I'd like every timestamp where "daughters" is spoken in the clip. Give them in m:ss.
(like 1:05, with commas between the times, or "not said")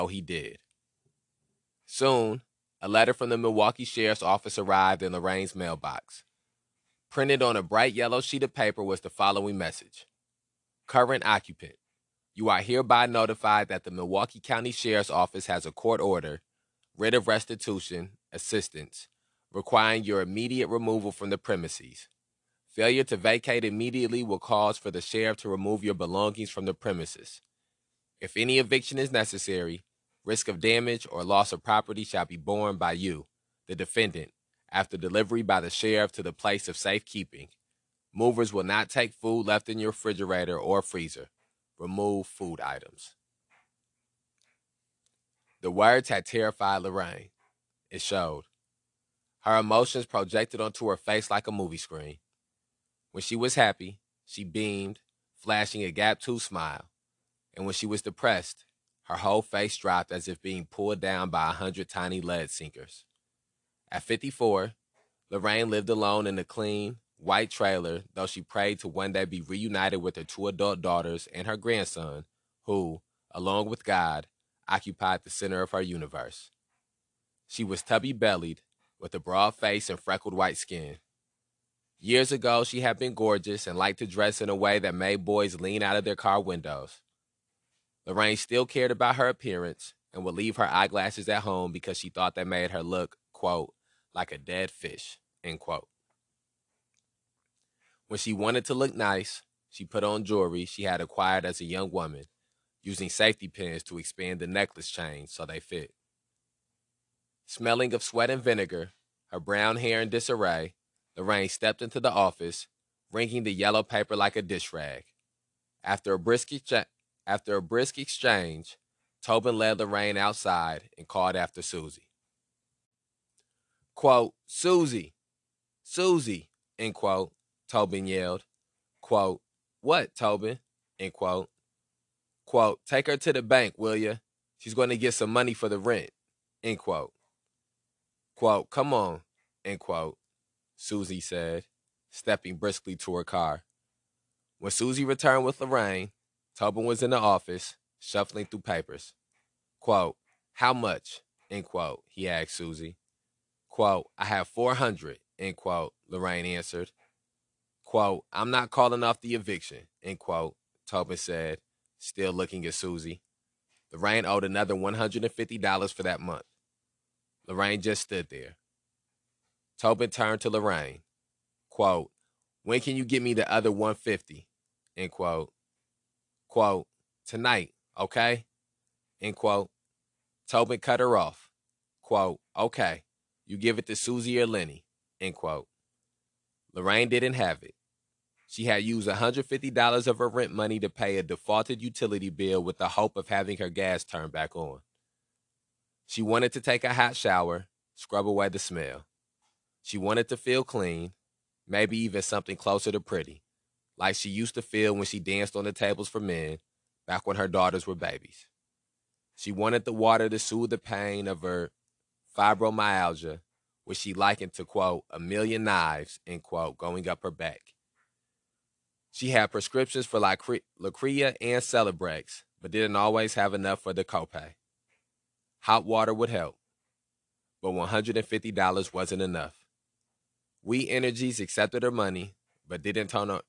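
1:10, 3:27.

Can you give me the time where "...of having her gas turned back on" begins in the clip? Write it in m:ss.
3:13.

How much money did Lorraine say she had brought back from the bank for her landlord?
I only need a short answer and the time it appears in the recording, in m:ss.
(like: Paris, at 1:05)
$400, at 2:34.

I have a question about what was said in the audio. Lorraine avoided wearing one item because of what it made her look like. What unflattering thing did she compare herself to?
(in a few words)
A dead fish.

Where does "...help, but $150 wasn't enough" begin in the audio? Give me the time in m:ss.
3:46.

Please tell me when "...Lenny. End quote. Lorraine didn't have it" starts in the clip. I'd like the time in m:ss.
3:04.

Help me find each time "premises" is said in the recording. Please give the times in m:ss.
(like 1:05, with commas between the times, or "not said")
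0:21, 0:26.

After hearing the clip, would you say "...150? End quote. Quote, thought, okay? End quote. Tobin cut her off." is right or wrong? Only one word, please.
wrong.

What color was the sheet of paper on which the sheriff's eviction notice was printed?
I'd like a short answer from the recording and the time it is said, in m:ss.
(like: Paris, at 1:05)
Bright yellow, at 0:07.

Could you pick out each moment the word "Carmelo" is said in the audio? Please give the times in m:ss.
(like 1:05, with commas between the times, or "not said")
not said.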